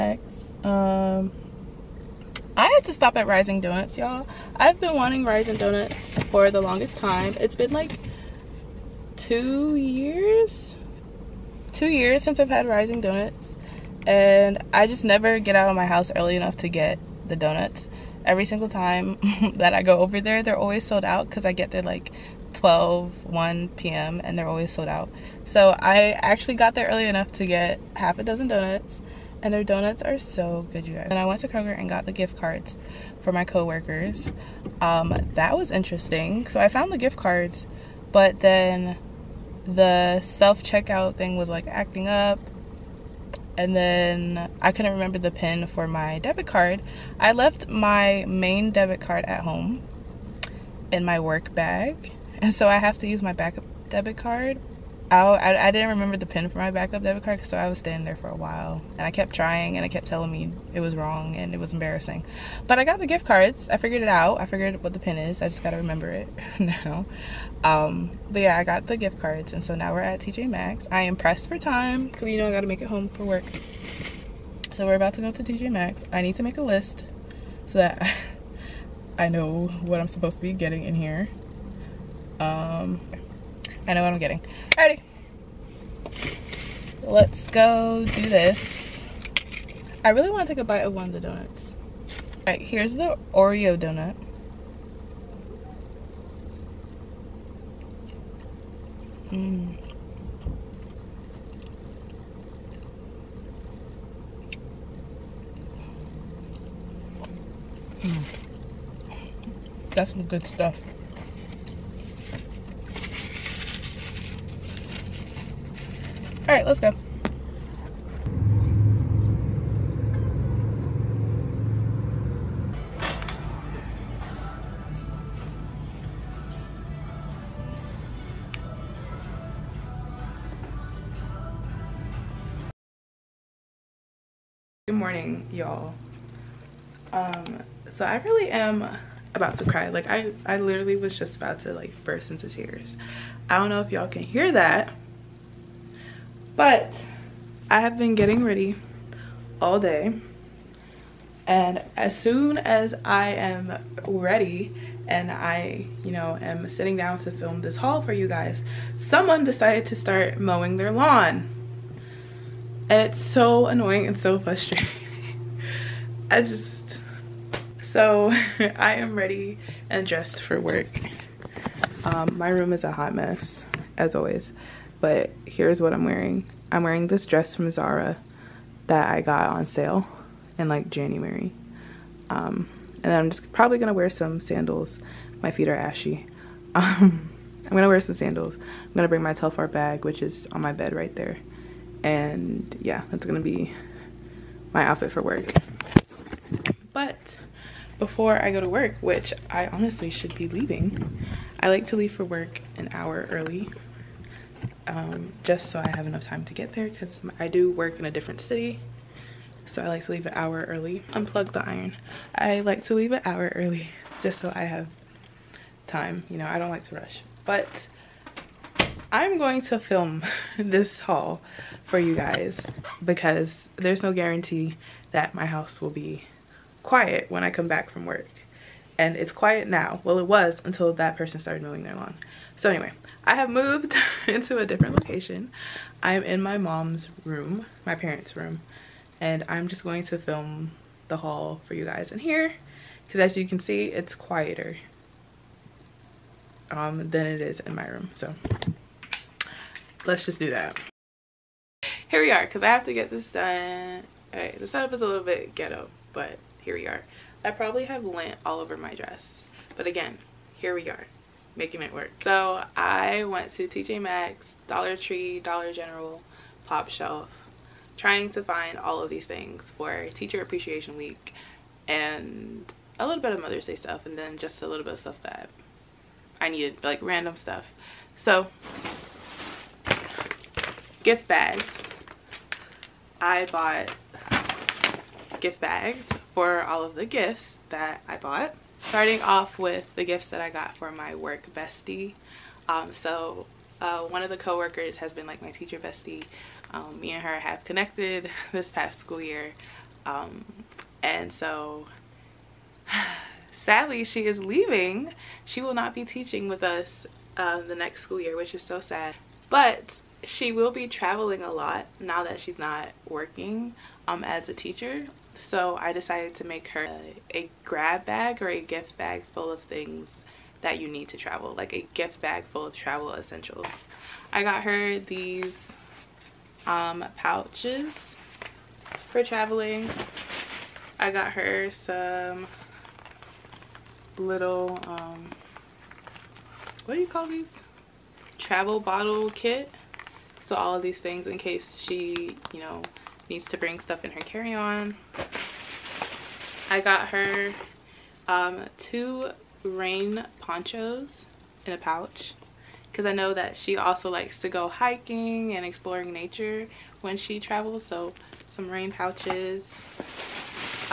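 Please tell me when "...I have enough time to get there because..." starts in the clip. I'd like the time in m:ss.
3:25.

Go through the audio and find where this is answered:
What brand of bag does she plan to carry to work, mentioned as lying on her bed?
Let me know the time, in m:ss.
3:09.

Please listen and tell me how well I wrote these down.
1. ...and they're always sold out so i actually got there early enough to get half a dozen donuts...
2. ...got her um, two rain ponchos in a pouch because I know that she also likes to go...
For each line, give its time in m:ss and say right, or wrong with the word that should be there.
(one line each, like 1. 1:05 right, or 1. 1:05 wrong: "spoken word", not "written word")
1. 0:24 right
2. 5:46 right.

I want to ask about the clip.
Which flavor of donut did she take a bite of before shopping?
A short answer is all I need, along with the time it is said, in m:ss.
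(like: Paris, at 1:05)
Oreo, at 1:33.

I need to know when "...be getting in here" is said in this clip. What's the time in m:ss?
1:20.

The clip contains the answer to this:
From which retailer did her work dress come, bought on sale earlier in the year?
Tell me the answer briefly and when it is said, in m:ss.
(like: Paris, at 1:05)
Zara, at 2:57.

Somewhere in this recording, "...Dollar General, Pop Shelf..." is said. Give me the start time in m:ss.
4:25.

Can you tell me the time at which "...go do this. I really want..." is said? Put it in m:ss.
1:27.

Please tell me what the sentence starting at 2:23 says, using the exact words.
I don't know if y'all can hear that, but I have been getting ready all day.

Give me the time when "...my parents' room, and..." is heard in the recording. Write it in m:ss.
3:57.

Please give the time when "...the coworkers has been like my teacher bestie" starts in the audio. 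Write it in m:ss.
4:54.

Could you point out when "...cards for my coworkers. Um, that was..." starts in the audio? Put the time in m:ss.
0:32.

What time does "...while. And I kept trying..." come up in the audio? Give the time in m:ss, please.
0:58.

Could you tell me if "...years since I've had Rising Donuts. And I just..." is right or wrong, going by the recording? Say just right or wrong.
right.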